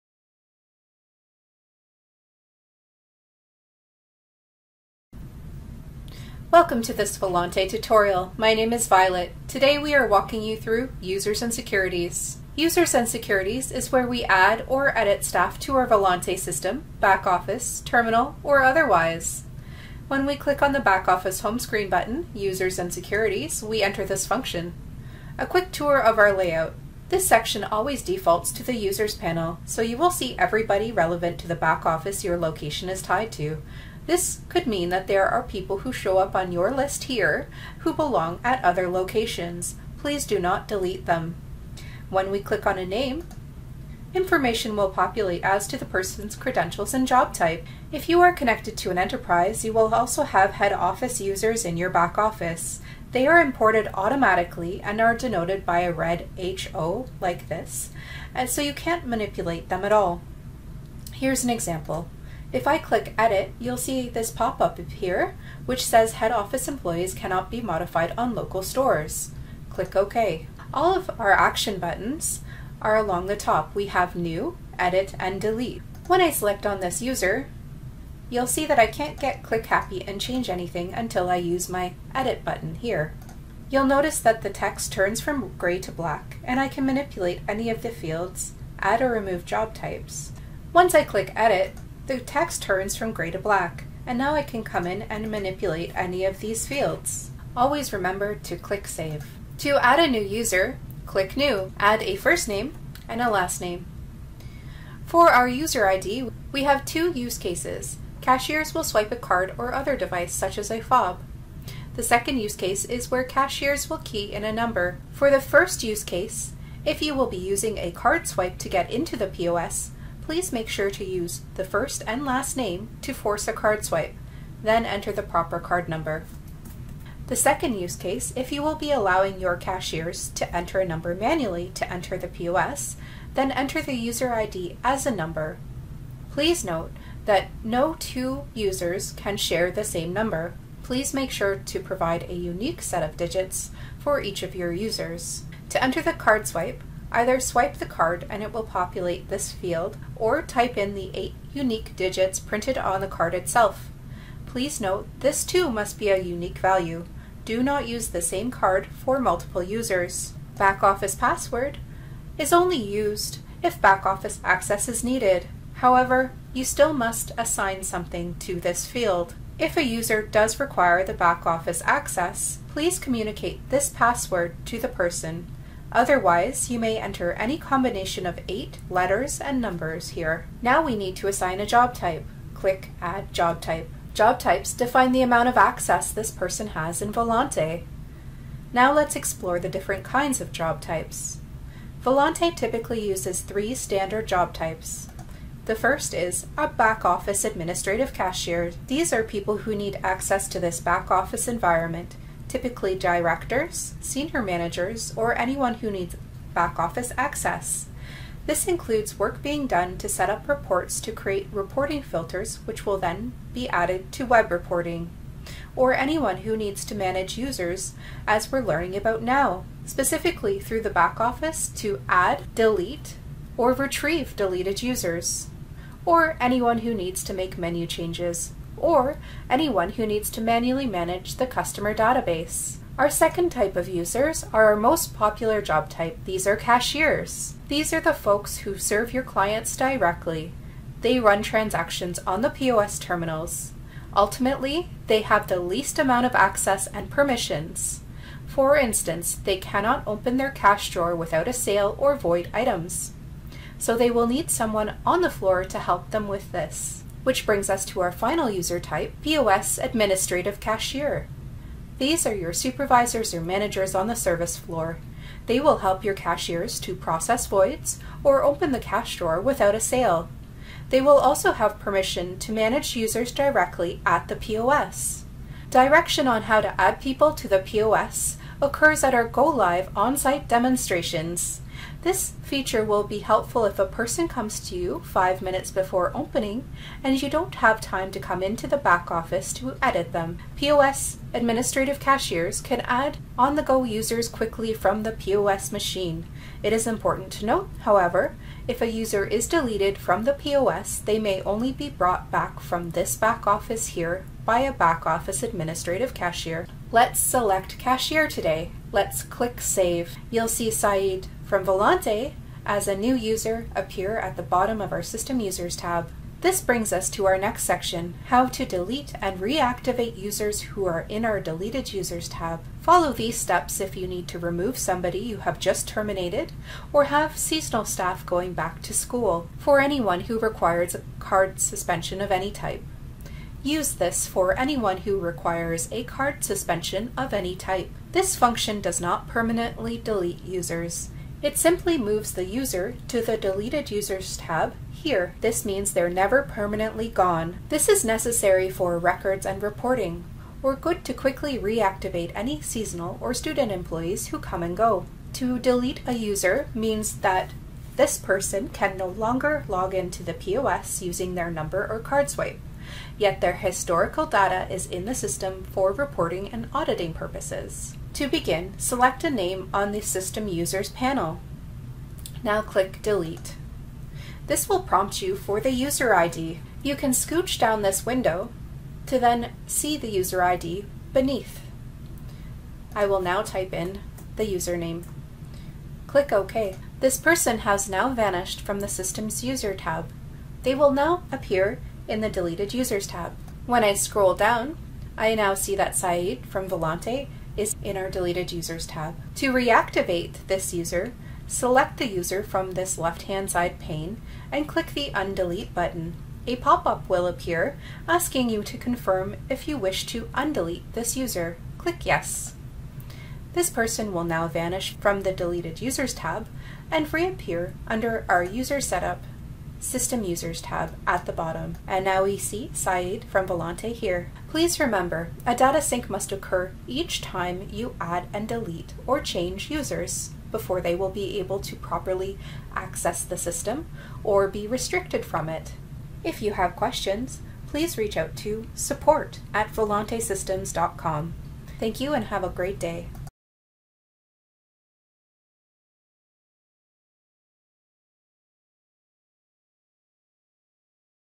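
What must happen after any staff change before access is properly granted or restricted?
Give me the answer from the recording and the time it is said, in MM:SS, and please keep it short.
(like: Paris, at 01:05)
data sync, at 07:05.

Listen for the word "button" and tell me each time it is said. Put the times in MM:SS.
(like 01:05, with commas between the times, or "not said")
00:21, 01:11, 01:22, 06:45.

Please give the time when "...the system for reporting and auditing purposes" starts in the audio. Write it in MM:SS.
06:05.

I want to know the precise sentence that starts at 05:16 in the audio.
This brings us to our next section, how to delete and reactivate users who are in our Deleted Users tab.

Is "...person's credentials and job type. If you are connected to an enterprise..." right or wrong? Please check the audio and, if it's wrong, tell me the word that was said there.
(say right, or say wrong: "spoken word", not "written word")
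right.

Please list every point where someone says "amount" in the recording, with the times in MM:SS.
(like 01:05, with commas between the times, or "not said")
03:05, 04:05.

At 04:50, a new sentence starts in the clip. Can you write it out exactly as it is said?
POS administrative cashiers can add on-the-go users quickly from the POS machine.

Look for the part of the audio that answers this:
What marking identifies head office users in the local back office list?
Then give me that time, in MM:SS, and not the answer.
00:55.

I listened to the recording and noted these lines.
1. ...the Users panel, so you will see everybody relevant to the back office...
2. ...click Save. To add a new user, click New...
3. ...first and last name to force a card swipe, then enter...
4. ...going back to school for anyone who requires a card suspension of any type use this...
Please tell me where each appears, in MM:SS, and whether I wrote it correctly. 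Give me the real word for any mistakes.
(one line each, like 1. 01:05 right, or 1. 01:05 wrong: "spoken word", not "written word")
1. 00:28 right
2. 01:38 right
3. 02:01 right
4. 05:28 right.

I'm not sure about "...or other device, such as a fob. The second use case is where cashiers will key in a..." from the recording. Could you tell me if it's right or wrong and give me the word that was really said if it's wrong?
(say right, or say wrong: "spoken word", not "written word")
right.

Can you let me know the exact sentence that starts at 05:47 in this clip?
This is necessary for records and reporting, or good to quickly reactivate any seasonal or student employees who come and go.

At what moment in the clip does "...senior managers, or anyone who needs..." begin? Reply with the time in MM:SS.
03:24.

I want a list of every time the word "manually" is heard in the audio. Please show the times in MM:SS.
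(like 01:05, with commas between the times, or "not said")
02:11, 03:50.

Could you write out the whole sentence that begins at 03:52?
Our second type of users are our most popular job type.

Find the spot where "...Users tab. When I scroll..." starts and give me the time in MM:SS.
06:32.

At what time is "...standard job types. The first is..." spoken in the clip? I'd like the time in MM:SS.
03:13.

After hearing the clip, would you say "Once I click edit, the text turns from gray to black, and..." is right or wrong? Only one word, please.
right.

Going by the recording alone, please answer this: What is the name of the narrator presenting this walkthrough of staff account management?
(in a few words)
Violet.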